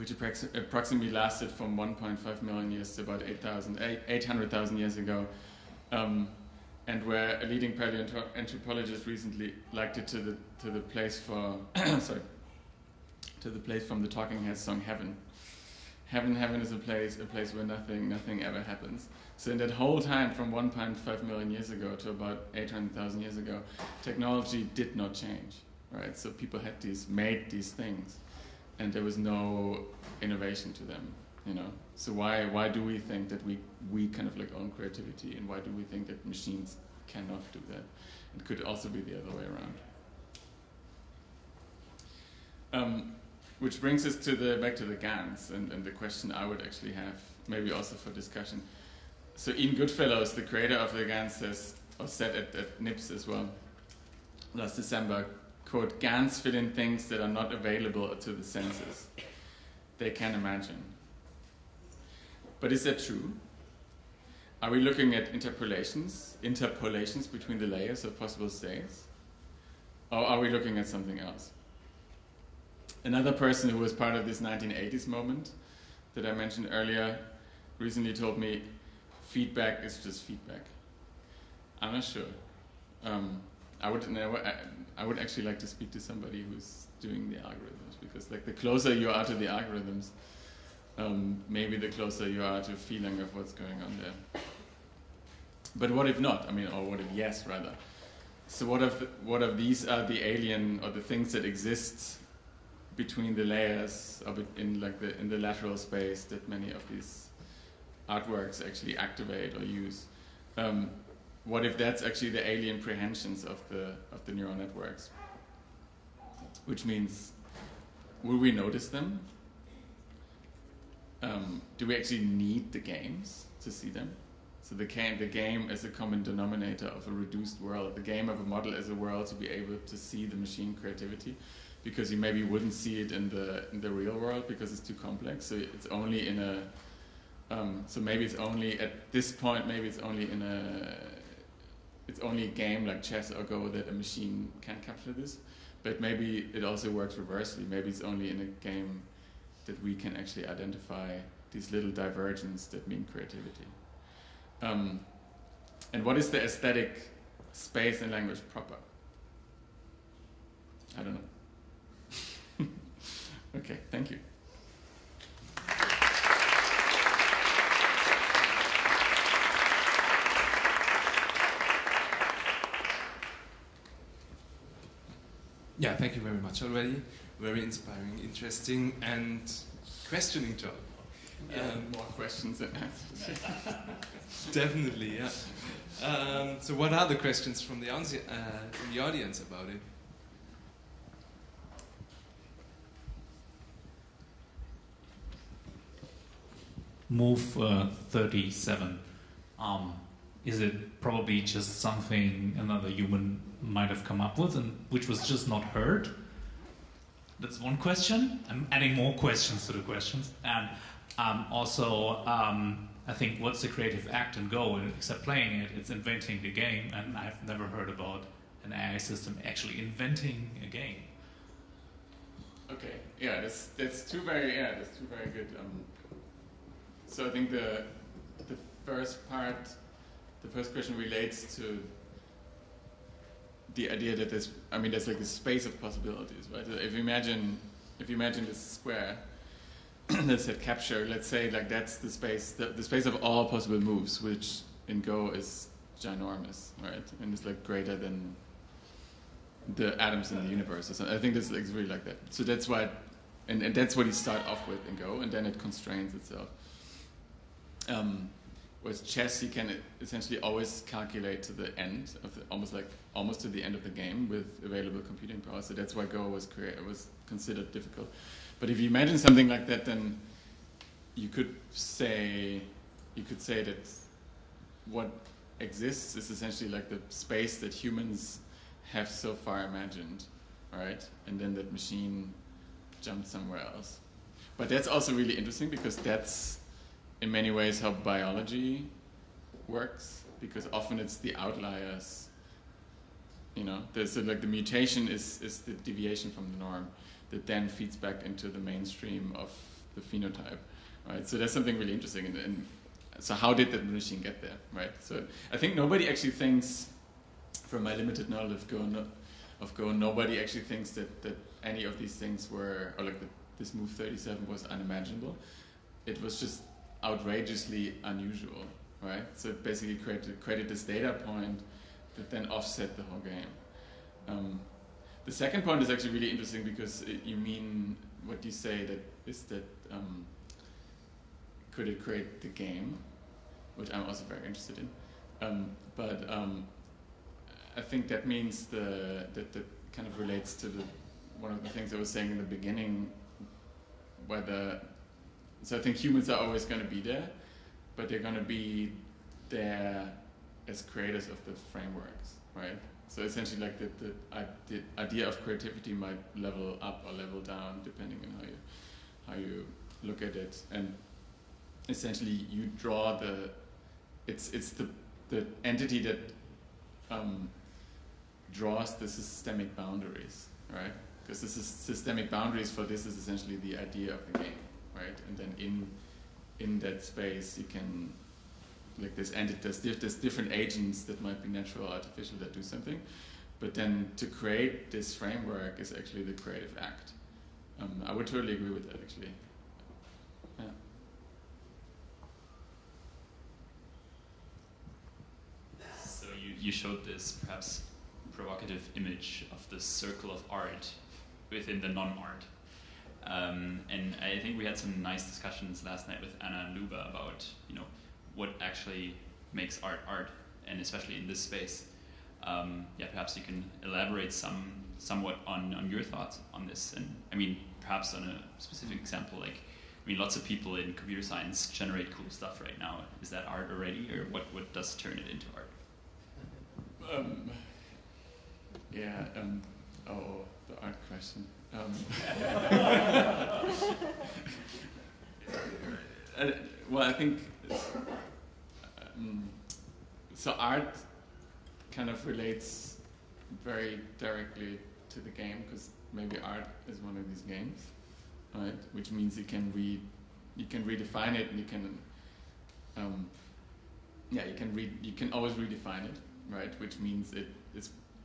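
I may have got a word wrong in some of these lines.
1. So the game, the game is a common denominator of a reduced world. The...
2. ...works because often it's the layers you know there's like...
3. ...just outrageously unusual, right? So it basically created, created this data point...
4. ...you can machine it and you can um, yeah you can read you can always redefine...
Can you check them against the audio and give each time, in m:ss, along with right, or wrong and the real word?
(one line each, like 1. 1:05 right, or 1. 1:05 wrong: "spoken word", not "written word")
1. 2:04 right
2. 4:49 wrong: "outliers", not "layers"
3. 5:16 right
4. 7:30 wrong: "redefine", not "machine".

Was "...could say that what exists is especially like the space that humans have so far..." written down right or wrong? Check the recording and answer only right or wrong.
wrong.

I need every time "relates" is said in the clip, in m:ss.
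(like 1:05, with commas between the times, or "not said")
3:50, 5:40, 7:22.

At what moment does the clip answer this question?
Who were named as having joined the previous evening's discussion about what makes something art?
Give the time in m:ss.
6:46.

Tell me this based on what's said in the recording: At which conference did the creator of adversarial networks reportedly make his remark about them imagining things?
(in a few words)
NIPS.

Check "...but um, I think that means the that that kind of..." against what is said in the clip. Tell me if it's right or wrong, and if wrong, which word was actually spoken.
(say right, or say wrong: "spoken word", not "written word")
right.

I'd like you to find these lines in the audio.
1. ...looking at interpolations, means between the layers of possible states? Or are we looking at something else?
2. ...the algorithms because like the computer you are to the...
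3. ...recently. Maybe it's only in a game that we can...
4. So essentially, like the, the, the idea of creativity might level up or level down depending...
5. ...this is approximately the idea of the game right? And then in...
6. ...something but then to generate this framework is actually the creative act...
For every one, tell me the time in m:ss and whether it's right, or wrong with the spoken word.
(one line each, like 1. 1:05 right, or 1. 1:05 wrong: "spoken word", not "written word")
1. 1:04 wrong: "interpolations", not "means"
2. 1:27 wrong: "closer", not "computer"
3. 2:27 wrong: "reversely", not "recently"
4. 5:53 right
5. 6:12 wrong: "essentially", not "approximately"
6. 6:22 wrong: "create", not "generate".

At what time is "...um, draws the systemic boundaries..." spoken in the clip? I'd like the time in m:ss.
6:07.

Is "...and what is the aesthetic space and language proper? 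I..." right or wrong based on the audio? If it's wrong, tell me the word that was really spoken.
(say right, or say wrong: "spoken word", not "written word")
right.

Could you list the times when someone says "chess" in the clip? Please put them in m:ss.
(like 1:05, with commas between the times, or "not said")
2:23, 4:19.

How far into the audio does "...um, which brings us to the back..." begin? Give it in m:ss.
0:42.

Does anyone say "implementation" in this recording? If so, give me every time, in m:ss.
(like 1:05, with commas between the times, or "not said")
not said.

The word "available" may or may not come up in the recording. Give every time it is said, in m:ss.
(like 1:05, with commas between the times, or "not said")
0:57, 4:24.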